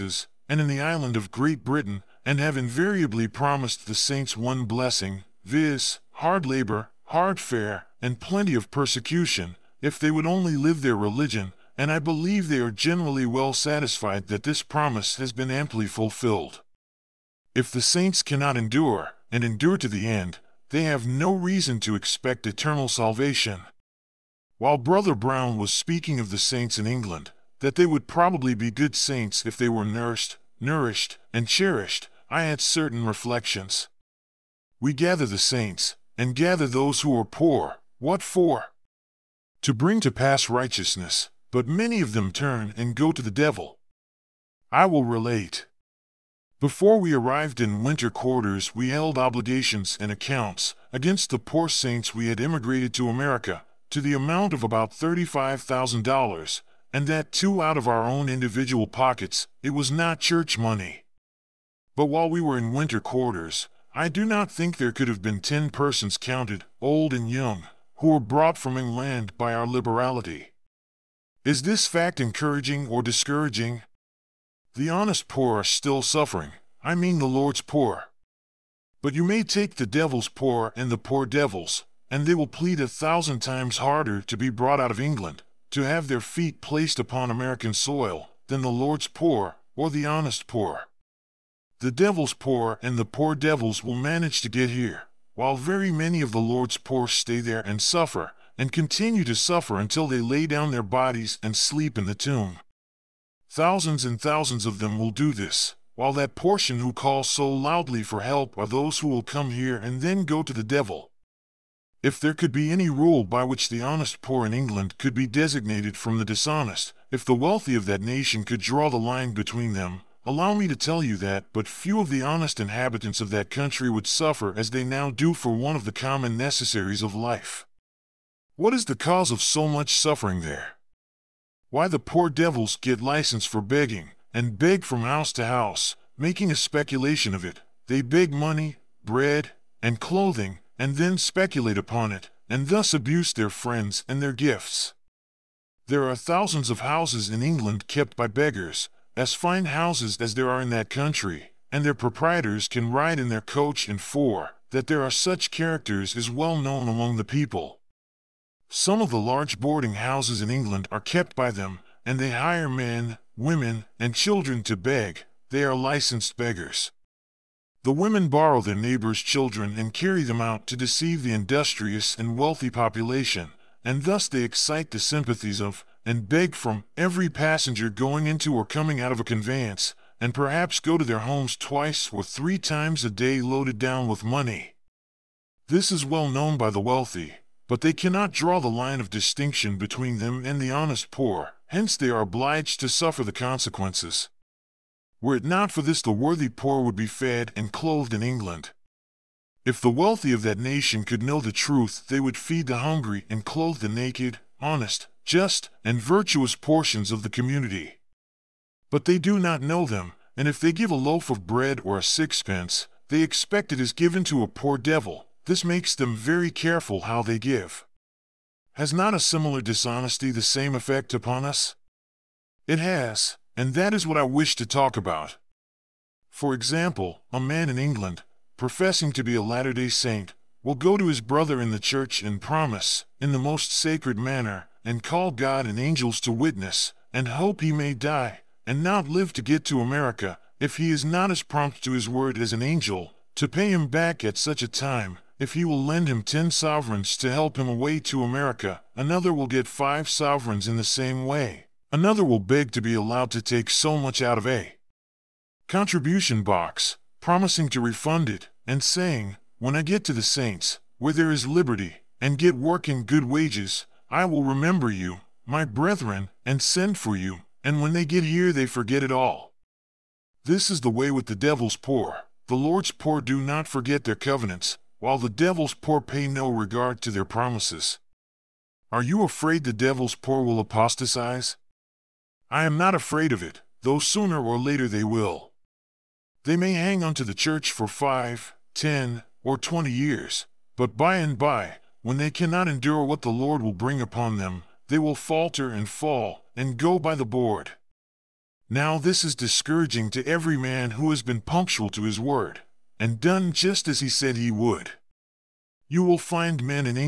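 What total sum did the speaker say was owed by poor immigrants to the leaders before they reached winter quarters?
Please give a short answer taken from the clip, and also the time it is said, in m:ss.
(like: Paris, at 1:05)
$35,000, at 0:54.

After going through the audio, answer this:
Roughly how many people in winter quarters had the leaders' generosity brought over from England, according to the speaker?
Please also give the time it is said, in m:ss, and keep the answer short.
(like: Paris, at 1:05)
10, at 1:05.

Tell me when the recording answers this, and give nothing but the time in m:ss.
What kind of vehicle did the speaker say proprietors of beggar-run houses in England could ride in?
2:33.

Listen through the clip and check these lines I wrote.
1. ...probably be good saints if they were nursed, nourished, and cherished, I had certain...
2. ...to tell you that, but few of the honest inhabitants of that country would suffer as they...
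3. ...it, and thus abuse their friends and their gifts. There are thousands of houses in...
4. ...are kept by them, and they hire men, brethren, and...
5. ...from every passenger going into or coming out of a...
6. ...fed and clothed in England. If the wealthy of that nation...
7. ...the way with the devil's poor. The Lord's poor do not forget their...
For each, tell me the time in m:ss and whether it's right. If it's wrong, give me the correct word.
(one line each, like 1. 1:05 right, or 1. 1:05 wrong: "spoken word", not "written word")
1. 0:28 right
2. 2:00 right
3. 2:22 right
4. 2:40 wrong: "women", not "brethren"
5. 2:56 right
6. 3:17 right
7. 4:30 right.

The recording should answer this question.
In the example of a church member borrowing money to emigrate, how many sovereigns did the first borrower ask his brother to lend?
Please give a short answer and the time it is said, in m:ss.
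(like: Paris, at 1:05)
10, at 4:06.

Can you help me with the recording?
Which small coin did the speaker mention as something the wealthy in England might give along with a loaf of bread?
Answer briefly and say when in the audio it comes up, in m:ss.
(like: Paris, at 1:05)
sixpence, at 3:32.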